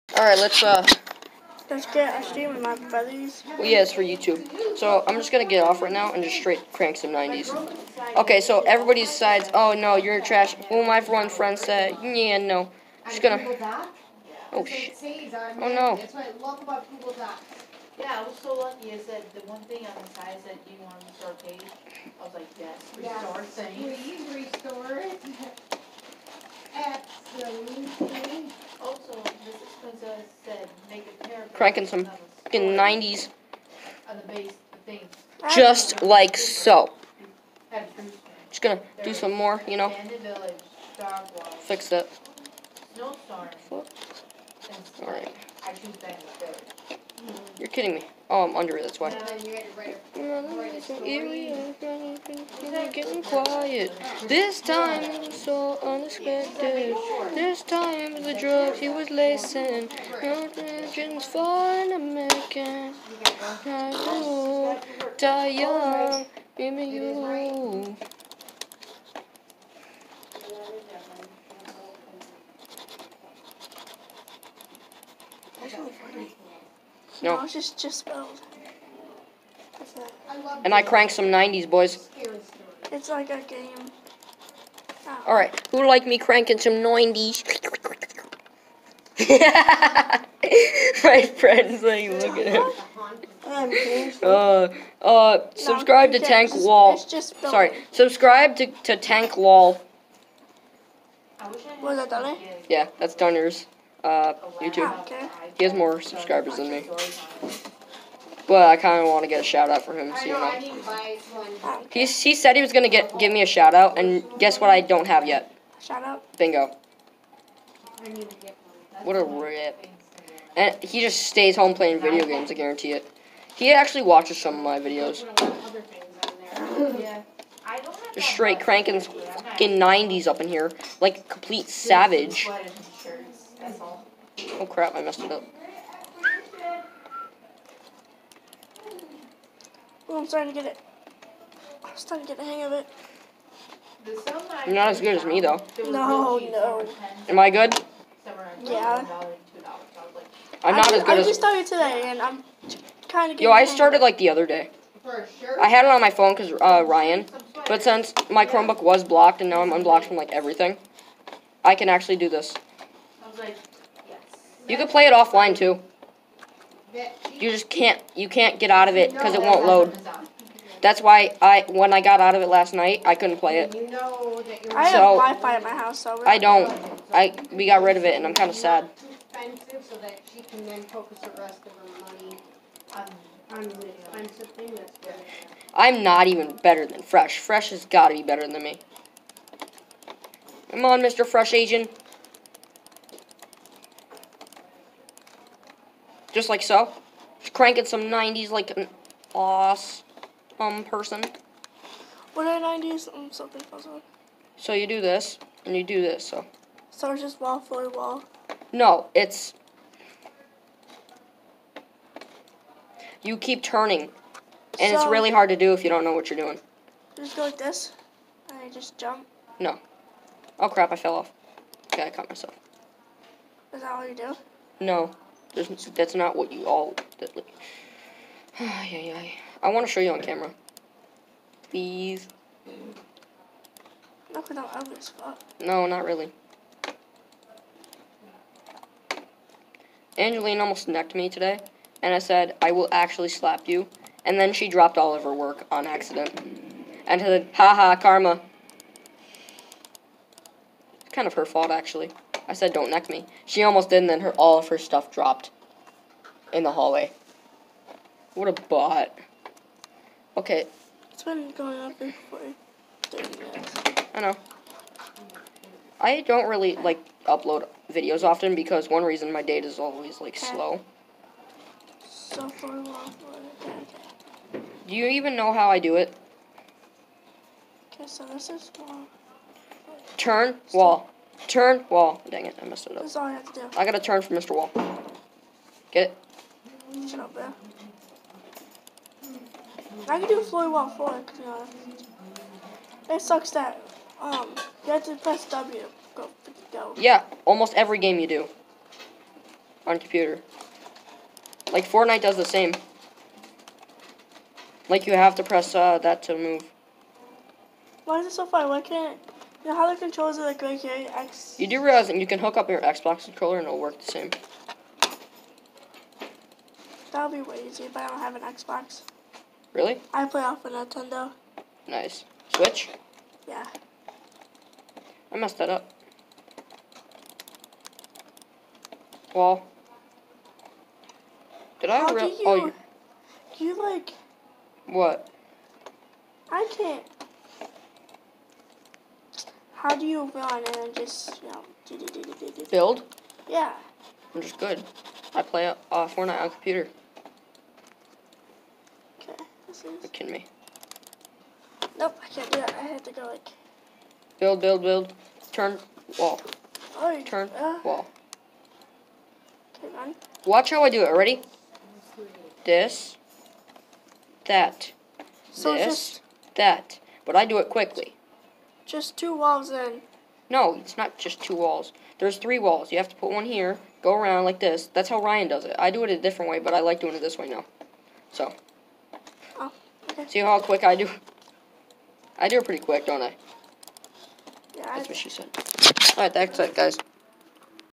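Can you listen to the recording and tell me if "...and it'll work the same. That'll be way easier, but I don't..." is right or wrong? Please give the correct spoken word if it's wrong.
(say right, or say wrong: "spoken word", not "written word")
right.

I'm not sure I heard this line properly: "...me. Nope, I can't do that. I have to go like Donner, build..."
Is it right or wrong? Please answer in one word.
wrong.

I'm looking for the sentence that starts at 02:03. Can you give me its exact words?
He actually watches some of my videos.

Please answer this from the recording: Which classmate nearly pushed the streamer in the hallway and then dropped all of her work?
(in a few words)
Angelina.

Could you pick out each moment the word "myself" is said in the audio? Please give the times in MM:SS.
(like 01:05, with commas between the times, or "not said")
03:42.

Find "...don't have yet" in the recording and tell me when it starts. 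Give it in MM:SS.
01:54.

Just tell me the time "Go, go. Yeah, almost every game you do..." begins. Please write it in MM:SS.
04:56.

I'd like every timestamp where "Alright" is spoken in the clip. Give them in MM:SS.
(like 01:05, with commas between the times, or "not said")
00:00, 00:45, 01:25, 06:26.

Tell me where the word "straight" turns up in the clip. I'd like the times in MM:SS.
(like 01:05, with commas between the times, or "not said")
00:06, 02:08.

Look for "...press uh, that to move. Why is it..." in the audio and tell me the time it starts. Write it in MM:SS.
05:05.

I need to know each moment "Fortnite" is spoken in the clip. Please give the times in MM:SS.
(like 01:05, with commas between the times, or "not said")
05:01, 05:46.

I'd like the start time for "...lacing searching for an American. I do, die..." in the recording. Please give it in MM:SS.
00:59.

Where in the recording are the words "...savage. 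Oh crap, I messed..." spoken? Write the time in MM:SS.
02:11.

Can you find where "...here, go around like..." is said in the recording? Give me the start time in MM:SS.
06:13.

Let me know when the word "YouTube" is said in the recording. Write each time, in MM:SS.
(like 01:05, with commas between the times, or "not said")
00:04, 01:44.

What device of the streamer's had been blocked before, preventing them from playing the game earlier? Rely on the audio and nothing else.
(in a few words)
Chromebook.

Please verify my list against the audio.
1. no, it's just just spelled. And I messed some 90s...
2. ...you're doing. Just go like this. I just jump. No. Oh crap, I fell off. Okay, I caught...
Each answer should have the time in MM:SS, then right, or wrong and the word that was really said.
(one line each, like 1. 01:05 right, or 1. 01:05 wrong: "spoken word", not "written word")
1. 01:17 wrong: "cranked", not "messed"
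2. 03:36 right.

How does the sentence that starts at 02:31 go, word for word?
I just started today, and I'm kind of.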